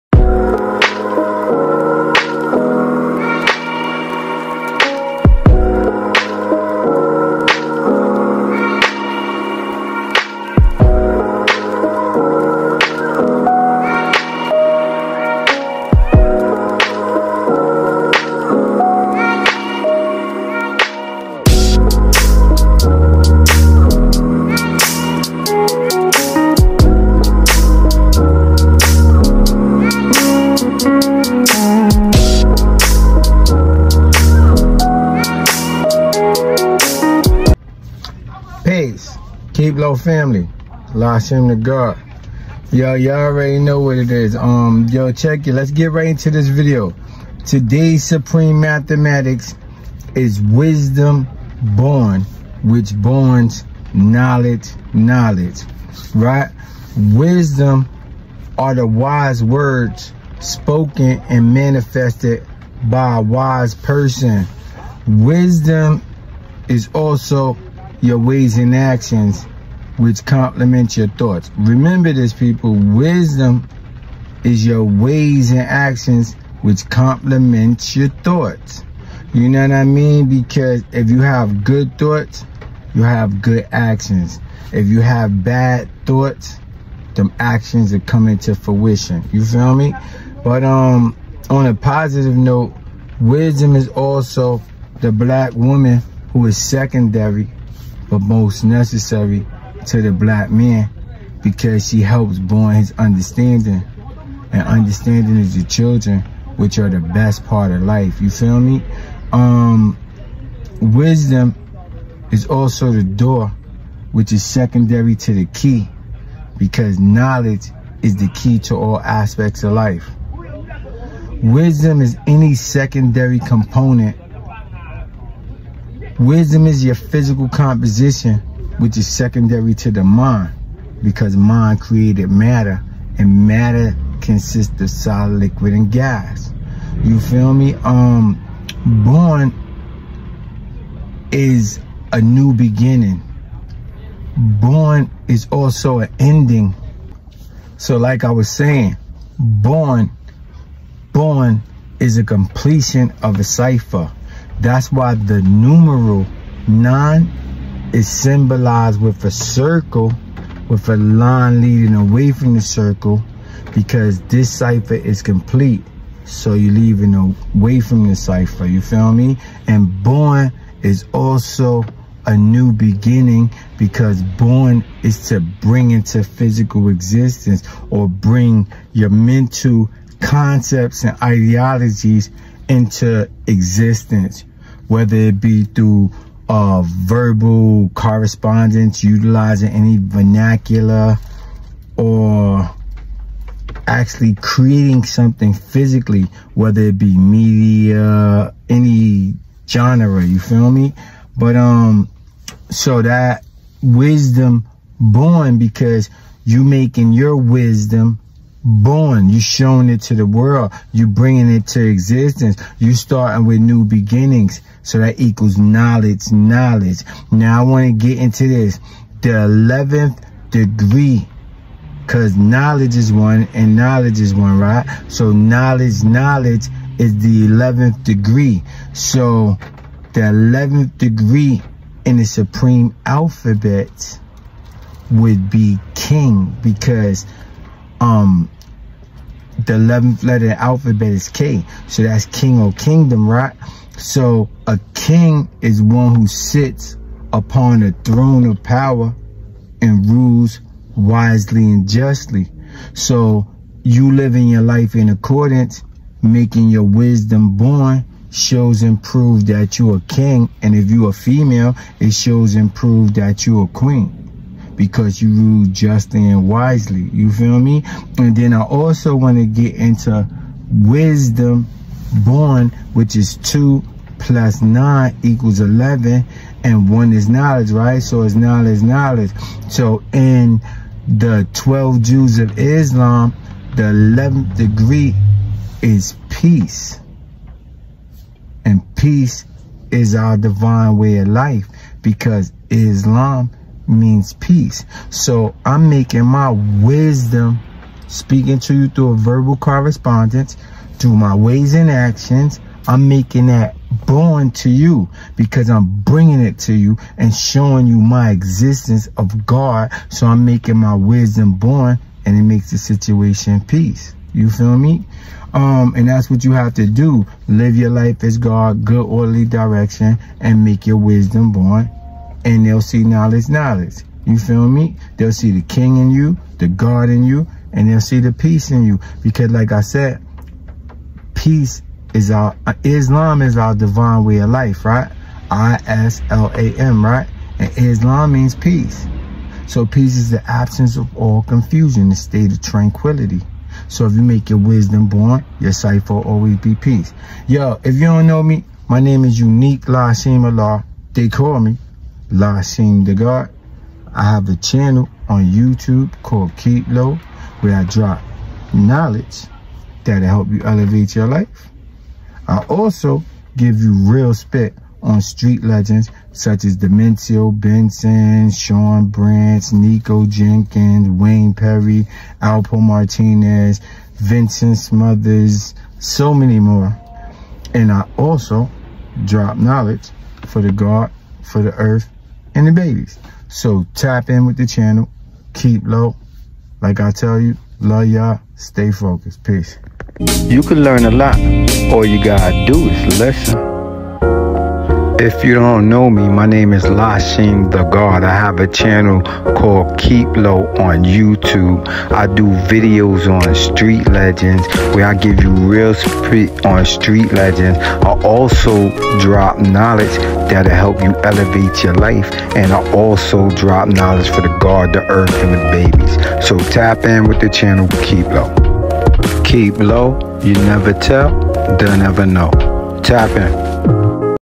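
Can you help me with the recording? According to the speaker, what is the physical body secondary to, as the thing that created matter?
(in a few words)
The mind.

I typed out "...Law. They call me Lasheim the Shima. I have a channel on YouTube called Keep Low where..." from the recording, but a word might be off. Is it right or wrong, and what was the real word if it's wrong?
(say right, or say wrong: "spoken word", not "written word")
wrong: "God", not "Shima".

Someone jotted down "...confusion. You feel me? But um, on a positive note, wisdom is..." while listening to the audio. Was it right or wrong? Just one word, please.
wrong.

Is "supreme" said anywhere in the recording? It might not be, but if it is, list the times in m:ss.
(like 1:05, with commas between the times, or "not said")
0:48, 3:52.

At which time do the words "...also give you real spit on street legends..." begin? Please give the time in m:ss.
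6:02.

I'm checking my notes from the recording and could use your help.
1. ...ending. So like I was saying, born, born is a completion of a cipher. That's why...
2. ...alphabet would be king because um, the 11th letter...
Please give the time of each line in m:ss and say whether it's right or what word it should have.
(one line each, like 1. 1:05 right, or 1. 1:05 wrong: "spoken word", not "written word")
1. 2:26 right
2. 3:53 right.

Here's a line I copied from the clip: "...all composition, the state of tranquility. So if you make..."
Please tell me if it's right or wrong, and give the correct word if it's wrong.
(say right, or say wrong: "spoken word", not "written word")
wrong: "confusion", not "composition".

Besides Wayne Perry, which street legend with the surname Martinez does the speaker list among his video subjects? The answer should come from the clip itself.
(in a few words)
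Alpo Martinez.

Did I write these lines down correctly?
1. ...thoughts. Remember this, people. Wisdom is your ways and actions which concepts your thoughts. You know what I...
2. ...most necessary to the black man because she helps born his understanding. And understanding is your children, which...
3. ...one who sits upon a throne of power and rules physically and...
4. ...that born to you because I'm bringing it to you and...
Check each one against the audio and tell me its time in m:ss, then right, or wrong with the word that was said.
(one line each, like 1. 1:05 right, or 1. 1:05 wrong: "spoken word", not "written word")
1. 1:11 wrong: "complements", not "concepts"
2. 1:38 right
3. 4:05 wrong: "wisely", not "physically"
4. 5:03 right.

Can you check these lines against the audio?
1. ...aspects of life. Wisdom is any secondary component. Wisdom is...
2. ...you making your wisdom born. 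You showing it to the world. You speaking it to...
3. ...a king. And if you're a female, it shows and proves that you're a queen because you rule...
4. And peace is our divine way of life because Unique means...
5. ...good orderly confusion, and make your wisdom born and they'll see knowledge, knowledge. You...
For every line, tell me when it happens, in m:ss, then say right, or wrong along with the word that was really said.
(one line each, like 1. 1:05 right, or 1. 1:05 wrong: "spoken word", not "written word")
1. 1:58 right
2. 3:26 wrong: "bringing", not "speaking"
3. 4:19 right
4. 4:48 wrong: "Islam", not "Unique"
5. 5:18 wrong: "direction", not "confusion".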